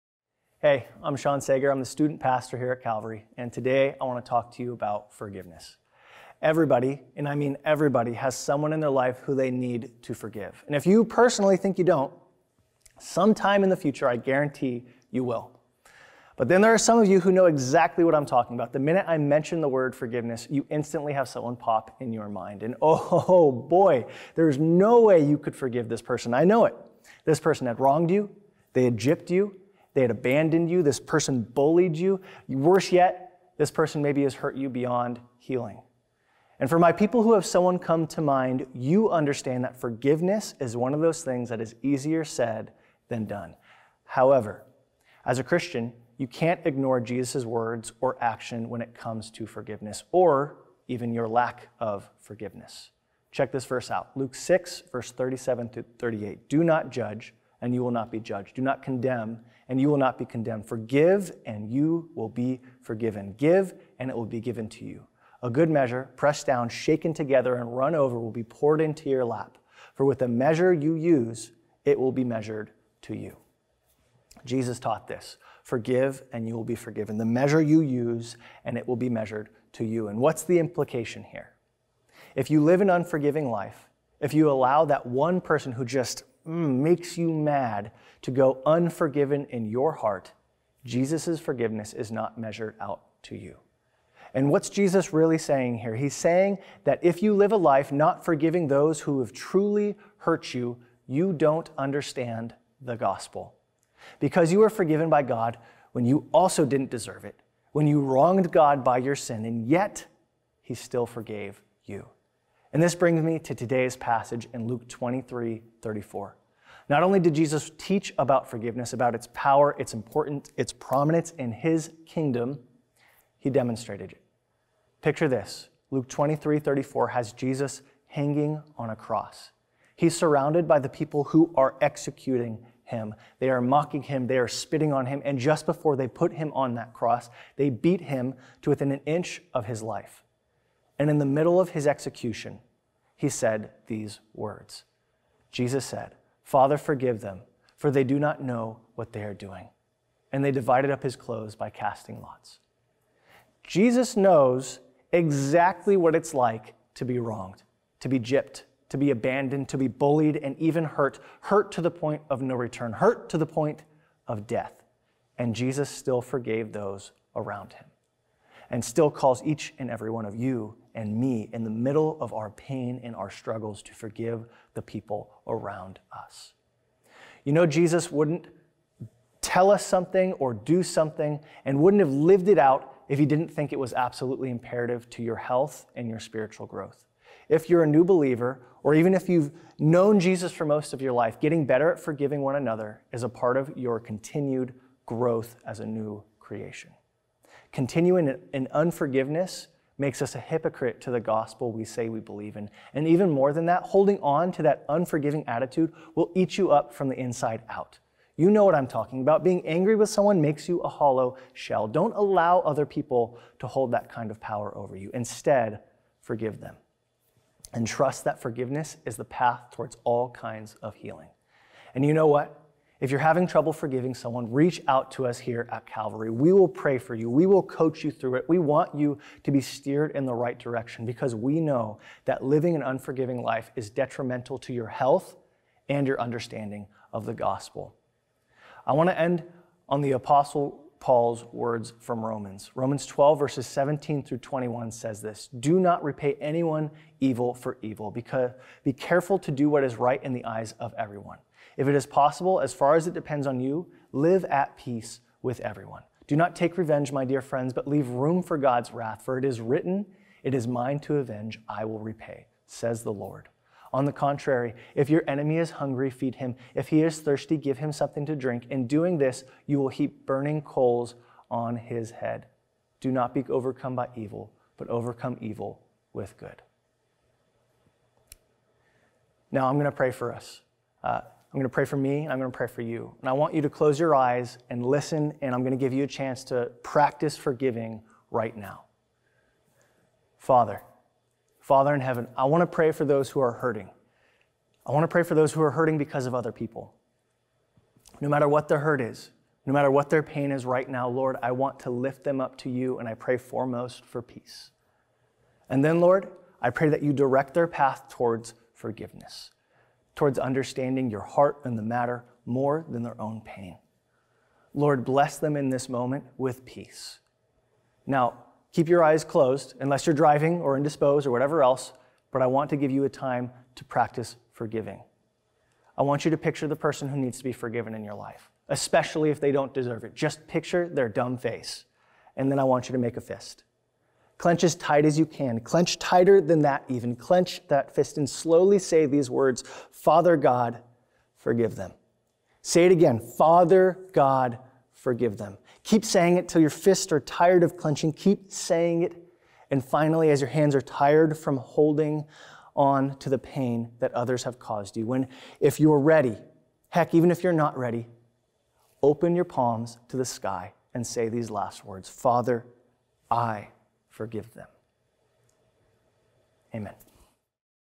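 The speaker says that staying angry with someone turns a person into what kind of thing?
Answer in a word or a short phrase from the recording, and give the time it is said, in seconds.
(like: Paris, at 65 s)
a hollow shell, at 210 s.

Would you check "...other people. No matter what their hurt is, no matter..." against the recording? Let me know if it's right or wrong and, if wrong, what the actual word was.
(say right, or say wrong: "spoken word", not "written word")
right.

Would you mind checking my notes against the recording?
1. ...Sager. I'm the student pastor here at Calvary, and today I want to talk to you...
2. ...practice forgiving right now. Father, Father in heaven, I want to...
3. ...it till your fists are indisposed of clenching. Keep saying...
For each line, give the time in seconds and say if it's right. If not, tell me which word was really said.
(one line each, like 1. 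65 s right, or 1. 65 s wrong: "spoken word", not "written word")
1. 1 s right
2. 286 s right
3. 346 s wrong: "tired", not "indisposed".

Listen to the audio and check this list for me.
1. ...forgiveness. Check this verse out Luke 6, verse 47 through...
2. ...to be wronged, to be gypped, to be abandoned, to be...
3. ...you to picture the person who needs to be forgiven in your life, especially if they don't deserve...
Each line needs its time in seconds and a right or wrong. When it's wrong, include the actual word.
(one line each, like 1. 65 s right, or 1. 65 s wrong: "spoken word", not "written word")
1. 52 s wrong: "37", not "47"
2. 156 s right
3. 326 s right.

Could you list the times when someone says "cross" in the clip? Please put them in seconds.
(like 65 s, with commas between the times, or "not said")
128 s, 136 s.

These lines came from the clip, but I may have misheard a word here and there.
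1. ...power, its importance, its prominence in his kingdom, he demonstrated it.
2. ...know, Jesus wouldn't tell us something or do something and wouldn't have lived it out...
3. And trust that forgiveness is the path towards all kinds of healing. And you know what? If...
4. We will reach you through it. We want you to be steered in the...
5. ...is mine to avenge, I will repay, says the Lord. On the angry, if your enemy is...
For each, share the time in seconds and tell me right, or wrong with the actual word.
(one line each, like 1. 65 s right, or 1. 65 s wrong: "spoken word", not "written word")
1. 119 s right
2. 177 s right
3. 217 s right
4. 227 s wrong: "coach", not "reach"
5. 260 s wrong: "contrary", not "angry".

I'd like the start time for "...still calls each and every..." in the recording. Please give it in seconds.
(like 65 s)
168 s.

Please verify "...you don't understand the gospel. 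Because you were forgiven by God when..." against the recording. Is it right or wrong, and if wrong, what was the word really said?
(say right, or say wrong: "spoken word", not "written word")
right.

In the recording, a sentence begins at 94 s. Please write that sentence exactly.
And what's Jesus really saying here?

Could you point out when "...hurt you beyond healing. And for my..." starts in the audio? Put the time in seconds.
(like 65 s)
34 s.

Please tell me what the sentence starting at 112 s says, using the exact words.
And this brings me to today's passage in Luke 23 34.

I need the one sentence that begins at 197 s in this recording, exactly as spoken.
Continuing in unforgiveness makes us a hypocrite to the gospel we say we believe in.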